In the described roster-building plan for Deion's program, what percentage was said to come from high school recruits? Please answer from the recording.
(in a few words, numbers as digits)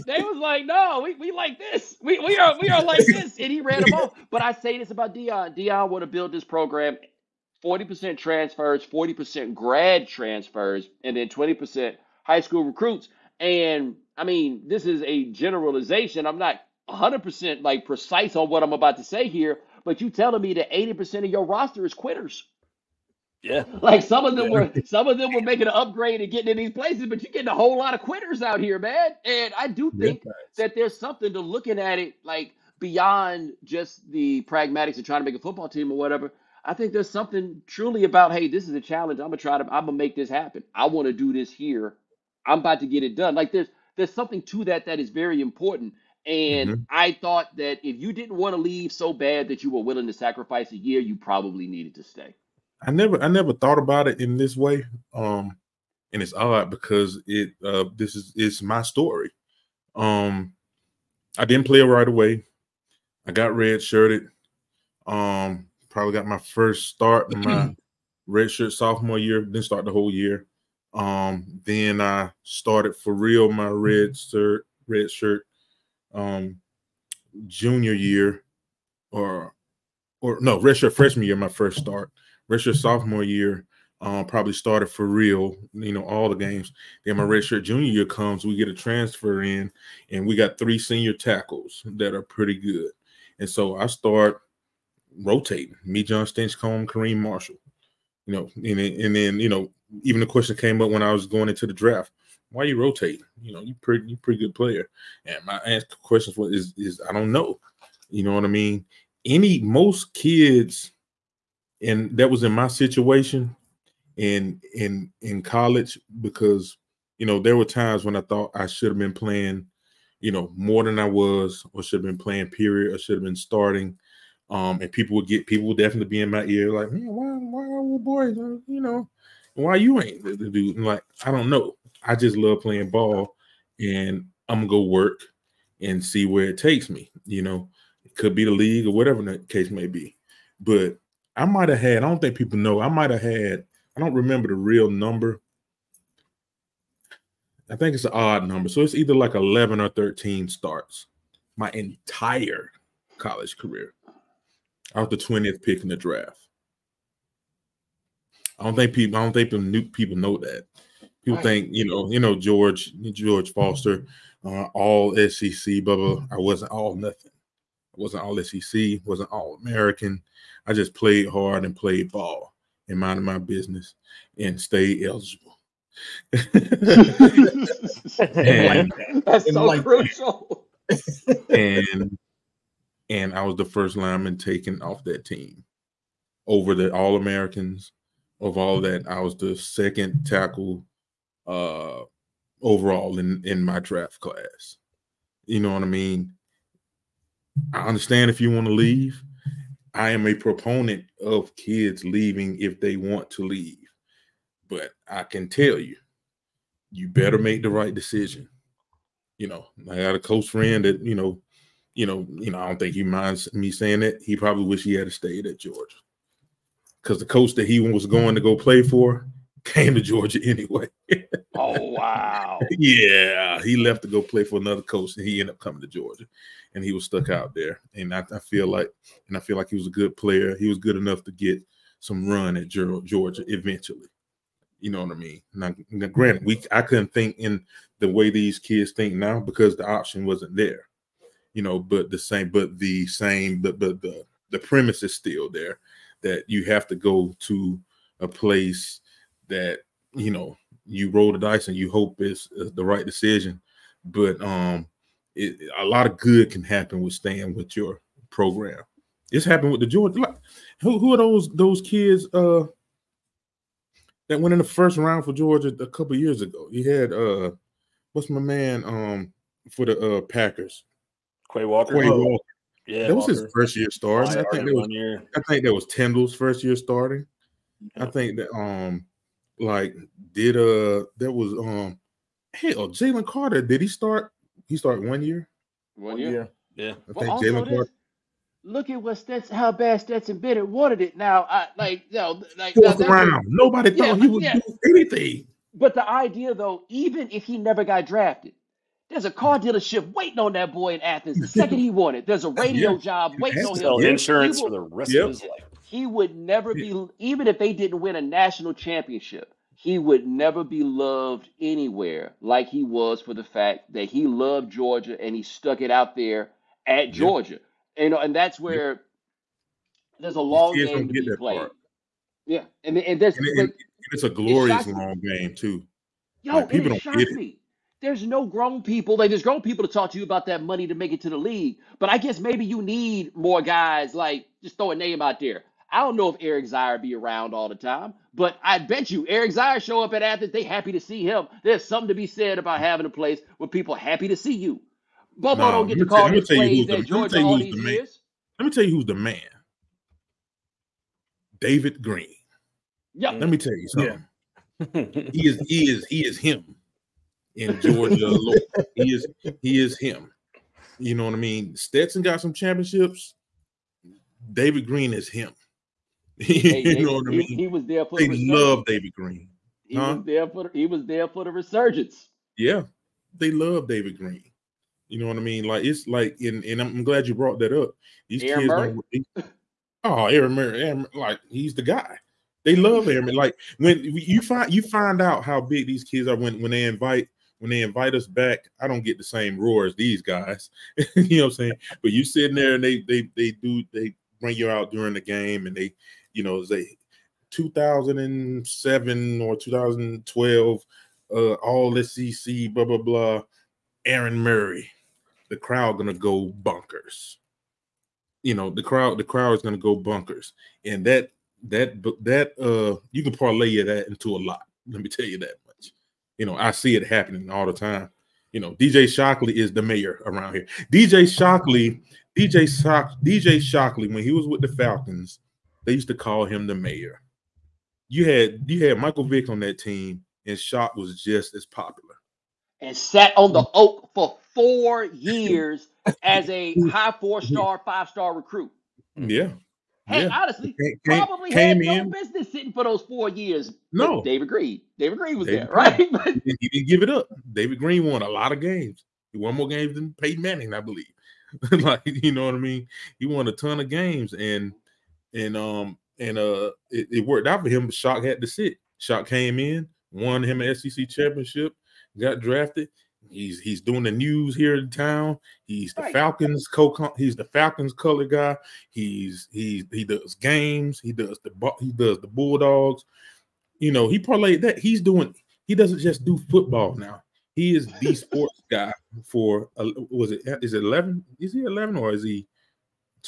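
20%.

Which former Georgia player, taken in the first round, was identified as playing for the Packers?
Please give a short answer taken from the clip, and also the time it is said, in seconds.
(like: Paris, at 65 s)
Quay Walker, at 271 s.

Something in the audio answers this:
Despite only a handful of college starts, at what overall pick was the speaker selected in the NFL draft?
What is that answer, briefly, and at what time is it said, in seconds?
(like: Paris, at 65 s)
20th pick, at 155 s.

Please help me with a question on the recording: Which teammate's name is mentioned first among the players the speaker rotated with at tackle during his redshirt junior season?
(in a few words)
Jon Stinchcomb.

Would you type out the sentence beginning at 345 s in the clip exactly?
Bobo no, don't get to call the plays that Georgia all these the years.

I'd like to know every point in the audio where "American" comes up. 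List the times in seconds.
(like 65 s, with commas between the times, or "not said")
169 s, 187 s.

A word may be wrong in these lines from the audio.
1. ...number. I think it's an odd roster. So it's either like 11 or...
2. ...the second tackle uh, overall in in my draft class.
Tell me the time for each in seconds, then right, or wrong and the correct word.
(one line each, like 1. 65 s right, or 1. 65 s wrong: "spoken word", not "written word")
1. 144 s wrong: "number", not "roster"
2. 189 s right.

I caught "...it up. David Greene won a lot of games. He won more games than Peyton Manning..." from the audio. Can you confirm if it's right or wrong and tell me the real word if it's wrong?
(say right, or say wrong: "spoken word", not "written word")
right.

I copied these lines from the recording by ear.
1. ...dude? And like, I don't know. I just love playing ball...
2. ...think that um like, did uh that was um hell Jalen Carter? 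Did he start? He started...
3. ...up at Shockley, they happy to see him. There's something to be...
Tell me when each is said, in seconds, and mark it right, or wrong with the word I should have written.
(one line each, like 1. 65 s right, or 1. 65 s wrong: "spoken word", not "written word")
1. 130 s right
2. 278 s right
3. 340 s wrong: "Athens", not "Shockley".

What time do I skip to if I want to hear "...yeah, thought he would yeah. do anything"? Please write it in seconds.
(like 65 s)
293 s.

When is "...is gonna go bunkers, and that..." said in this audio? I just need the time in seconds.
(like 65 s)
409 s.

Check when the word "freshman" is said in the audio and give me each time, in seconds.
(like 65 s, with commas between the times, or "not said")
80 s.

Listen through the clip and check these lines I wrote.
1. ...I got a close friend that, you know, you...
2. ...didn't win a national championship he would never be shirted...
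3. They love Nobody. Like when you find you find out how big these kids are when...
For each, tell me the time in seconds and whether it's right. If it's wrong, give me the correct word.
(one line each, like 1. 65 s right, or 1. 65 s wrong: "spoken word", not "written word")
1. 209 s right
2. 307 s wrong: "loved", not "shirted"
3. 382 s wrong: "Aaron", not "Nobody".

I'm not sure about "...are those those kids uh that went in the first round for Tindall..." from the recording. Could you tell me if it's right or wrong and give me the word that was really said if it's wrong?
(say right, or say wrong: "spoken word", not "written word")
wrong: "Georgia", not "Tindall".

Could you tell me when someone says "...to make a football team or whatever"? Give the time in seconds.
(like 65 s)
35 s.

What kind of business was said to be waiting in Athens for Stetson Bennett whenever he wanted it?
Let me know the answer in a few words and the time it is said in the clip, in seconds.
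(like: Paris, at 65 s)
Car dealership, at 299 s.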